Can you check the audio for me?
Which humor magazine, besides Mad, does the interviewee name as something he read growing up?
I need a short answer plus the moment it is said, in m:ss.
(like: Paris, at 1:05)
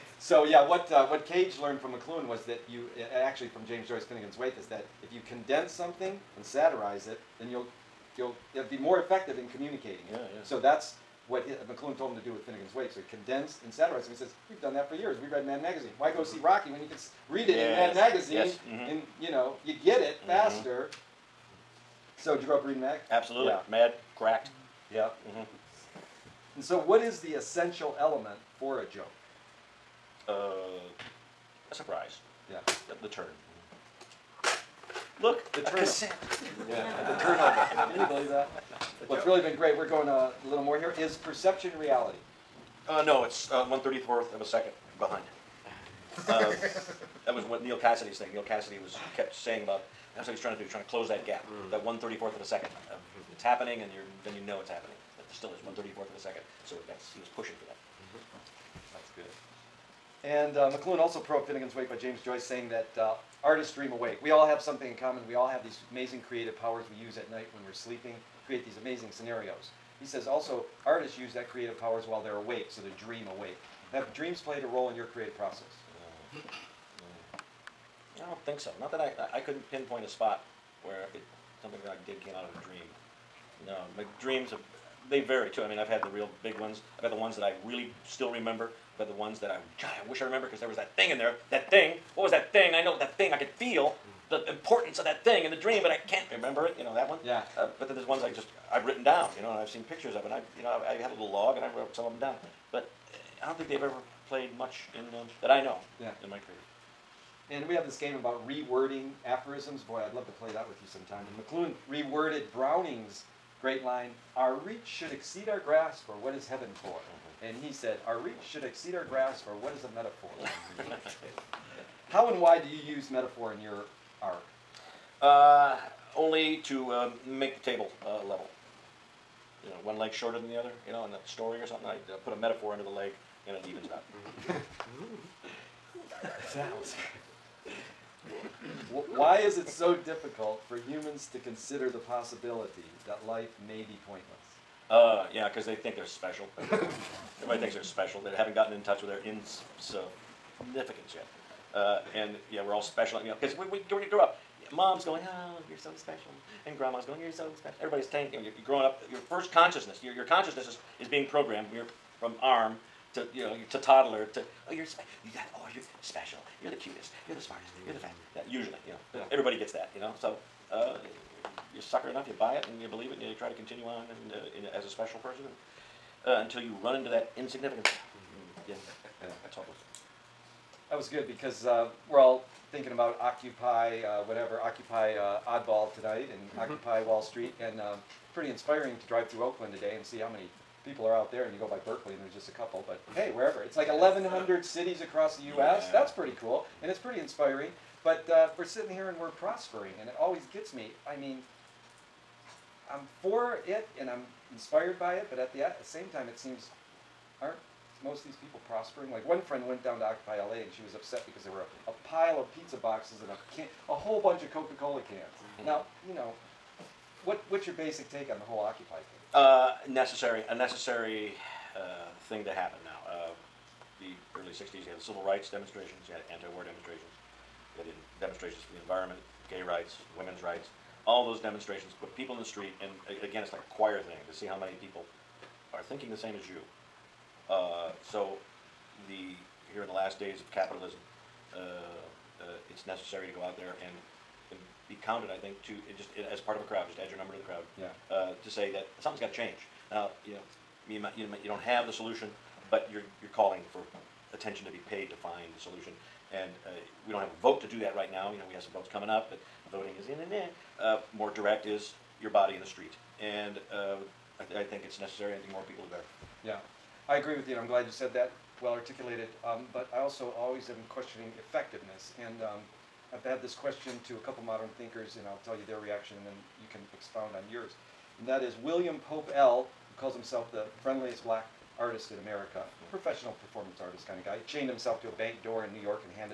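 Cracked, at 0:24.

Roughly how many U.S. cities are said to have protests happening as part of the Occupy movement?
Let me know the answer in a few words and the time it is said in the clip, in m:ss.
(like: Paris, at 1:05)
1,100, at 3:13.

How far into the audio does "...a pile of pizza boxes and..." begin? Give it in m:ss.
3:31.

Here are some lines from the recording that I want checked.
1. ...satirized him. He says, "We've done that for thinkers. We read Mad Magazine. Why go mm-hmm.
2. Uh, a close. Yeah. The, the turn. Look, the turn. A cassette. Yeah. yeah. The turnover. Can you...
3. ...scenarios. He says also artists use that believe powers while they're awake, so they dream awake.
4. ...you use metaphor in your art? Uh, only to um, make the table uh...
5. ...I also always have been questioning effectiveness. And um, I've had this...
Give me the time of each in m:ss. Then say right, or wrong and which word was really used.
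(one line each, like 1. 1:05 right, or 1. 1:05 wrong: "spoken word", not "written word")
1. 0:13 wrong: "years", not "thinkers"
2. 0:30 wrong: "surprise", not "close"
3. 1:09 wrong: "creative", not "believe"
4. 2:02 right
5. 4:29 right.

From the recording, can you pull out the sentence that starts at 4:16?
And uh, we don't have a vote to do that right now.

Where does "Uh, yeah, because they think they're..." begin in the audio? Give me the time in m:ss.
2:24.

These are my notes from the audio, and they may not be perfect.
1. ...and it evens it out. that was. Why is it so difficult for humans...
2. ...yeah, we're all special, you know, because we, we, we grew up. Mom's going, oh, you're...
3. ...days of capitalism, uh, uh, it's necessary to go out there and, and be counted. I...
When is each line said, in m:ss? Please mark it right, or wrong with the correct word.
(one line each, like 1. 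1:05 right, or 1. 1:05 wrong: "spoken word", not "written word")
1. 2:13 right
2. 2:32 right
3. 4:00 right.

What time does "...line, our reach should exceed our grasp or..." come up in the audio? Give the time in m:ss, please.
1:53.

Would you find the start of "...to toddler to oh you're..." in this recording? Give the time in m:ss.
2:43.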